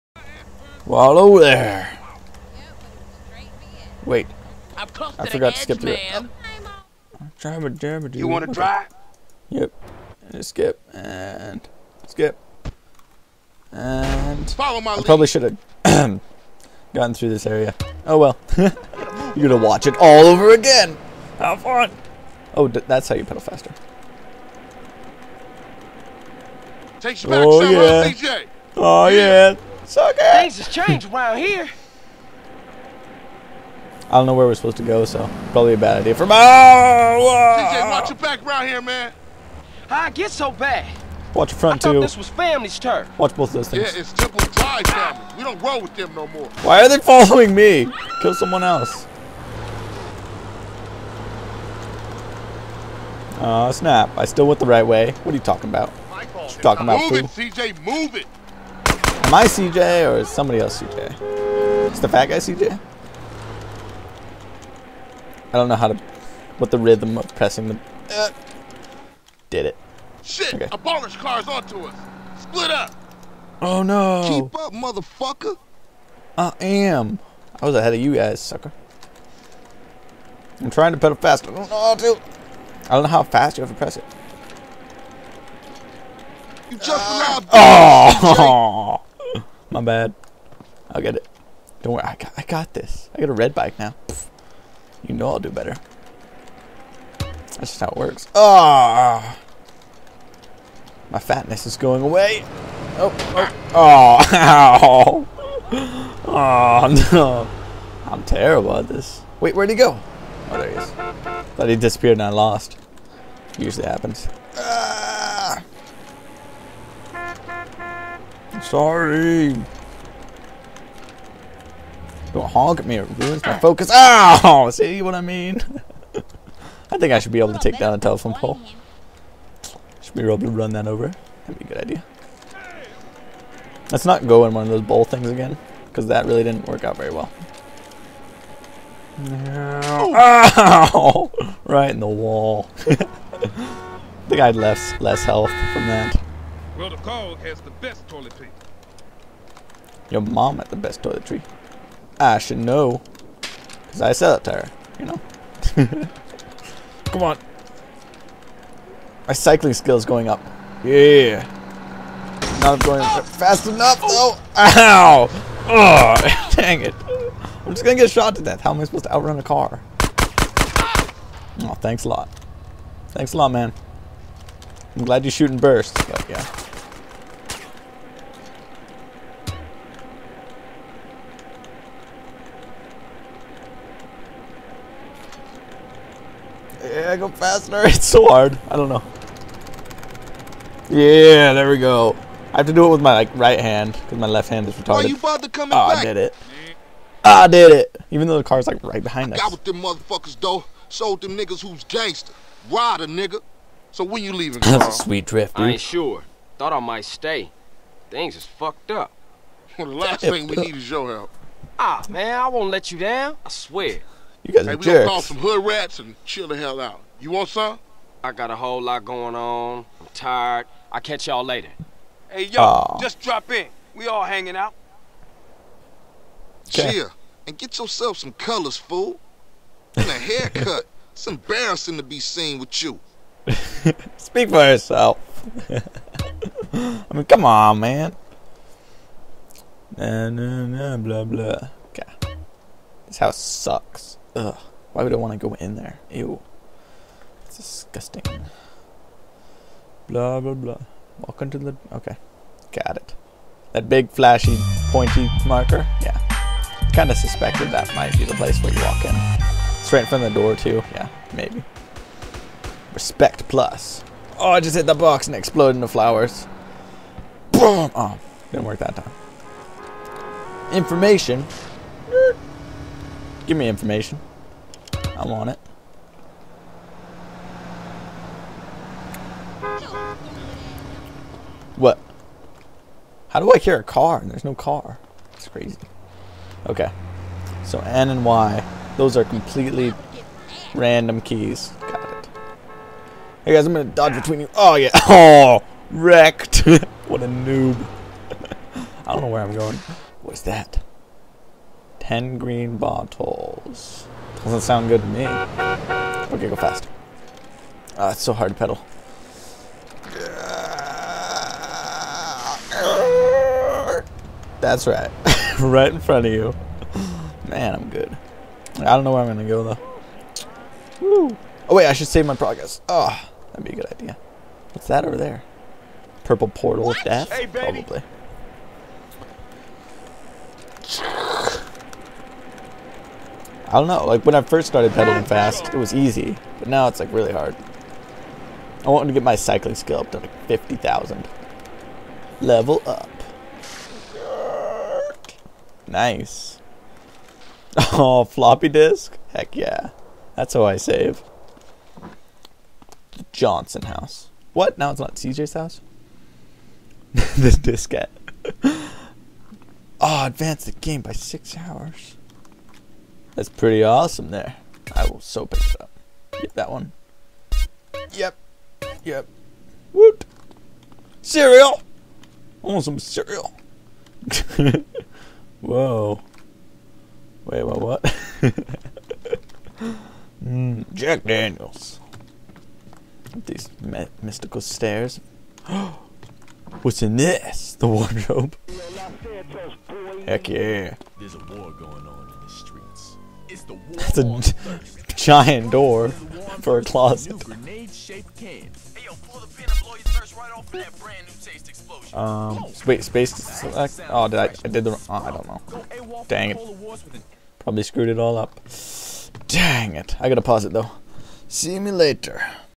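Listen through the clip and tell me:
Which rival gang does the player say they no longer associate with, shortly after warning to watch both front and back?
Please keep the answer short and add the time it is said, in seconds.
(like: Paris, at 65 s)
Temple Drive family, at 44 s.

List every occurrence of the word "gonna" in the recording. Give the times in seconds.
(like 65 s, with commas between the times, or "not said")
19 s, 293 s, 319 s.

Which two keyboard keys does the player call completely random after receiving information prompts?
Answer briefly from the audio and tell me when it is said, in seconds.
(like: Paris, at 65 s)
N and Y, at 287 s.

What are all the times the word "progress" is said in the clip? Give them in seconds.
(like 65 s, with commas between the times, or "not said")
322 s.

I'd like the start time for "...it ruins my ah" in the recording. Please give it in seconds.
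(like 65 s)
122 s.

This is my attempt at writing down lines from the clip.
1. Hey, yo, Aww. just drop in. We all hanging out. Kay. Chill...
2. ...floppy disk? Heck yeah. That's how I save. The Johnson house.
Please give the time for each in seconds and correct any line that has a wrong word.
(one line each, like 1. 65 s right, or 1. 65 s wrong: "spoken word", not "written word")
1. 222 s right
2. 348 s right.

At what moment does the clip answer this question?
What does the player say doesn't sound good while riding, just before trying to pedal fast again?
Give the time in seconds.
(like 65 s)
302 s.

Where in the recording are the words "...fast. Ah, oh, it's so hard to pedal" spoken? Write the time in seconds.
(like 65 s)
306 s.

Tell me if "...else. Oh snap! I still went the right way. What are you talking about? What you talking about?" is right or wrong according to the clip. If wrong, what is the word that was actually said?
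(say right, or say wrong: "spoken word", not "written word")
right.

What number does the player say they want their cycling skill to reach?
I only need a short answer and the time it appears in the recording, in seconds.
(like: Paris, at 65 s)
50,000, at 340 s.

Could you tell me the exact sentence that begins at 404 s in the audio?
Oh, did I, I did the, oh, I don't know.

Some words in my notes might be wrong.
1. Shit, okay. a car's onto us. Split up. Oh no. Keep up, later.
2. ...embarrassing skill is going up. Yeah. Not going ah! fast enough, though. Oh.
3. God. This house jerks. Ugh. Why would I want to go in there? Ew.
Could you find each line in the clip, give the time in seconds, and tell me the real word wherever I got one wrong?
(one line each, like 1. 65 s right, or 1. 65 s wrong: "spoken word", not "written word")
1. 70 s wrong: "motherfucker", not "later"
2. 159 s wrong: "cycling", not "embarrassing"
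3. 241 s wrong: "sucks", not "jerks".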